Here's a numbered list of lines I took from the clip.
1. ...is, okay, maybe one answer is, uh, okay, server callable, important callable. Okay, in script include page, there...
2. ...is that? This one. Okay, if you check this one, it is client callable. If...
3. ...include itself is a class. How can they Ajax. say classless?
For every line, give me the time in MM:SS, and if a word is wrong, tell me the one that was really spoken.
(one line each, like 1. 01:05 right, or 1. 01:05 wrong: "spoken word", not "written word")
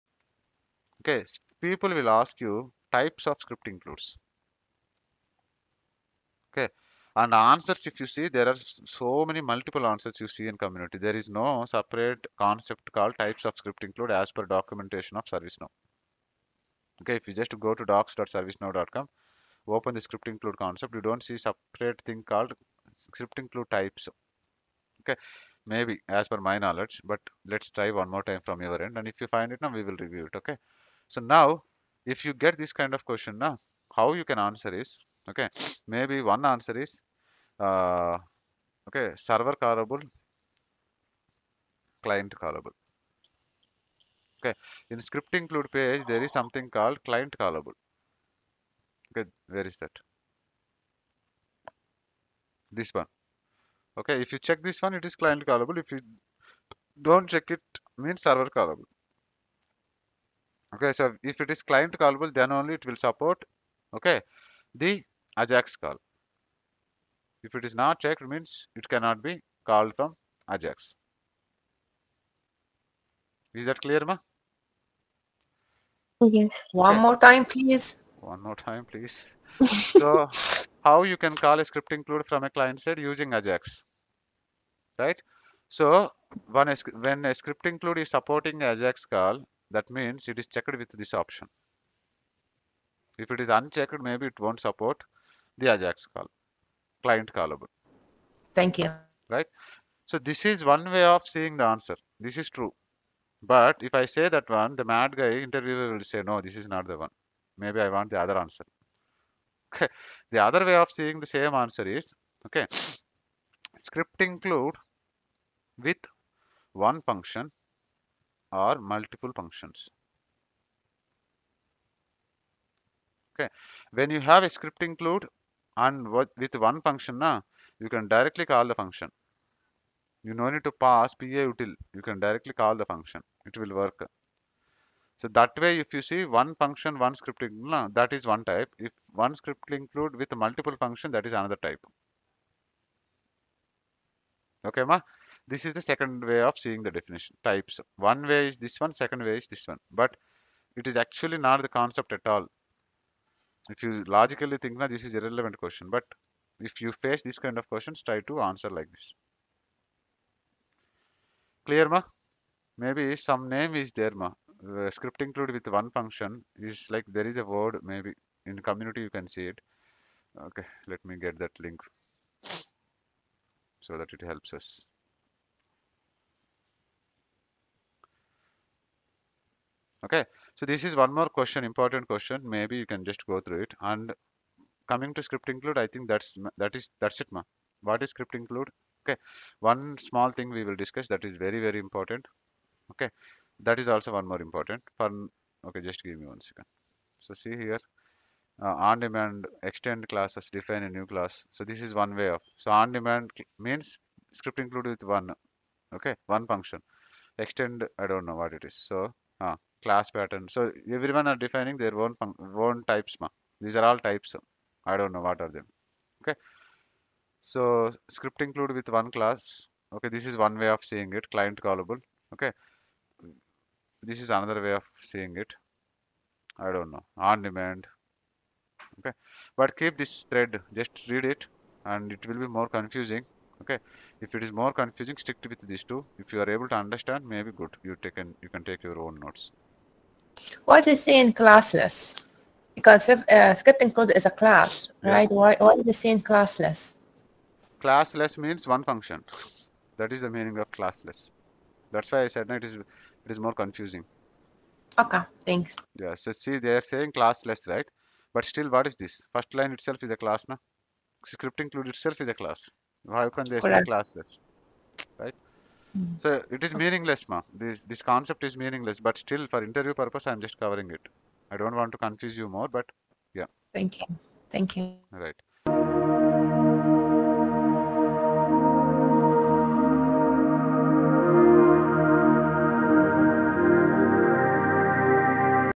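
1. 00:34 wrong: "client", not "important"
2. 00:49 right
3. 04:21 wrong: "Correct", not "Ajax".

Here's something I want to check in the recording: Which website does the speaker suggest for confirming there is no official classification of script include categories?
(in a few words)
docs.servicenow.com.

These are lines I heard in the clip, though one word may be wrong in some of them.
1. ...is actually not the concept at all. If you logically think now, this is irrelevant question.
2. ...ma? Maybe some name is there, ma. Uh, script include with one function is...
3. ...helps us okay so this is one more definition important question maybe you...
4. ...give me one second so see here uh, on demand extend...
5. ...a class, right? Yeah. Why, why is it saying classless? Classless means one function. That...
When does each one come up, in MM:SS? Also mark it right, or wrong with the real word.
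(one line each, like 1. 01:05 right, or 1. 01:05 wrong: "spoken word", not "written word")
1. 02:30 right
2. 02:41 right
3. 02:54 wrong: "question", not "definition"
4. 03:16 right
5. 04:04 right.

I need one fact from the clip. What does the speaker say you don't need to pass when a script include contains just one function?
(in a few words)
PA util.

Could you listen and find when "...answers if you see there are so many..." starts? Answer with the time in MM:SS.
00:07.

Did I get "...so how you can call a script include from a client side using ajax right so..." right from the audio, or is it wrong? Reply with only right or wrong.
right.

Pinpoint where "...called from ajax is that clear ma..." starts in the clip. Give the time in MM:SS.
01:09.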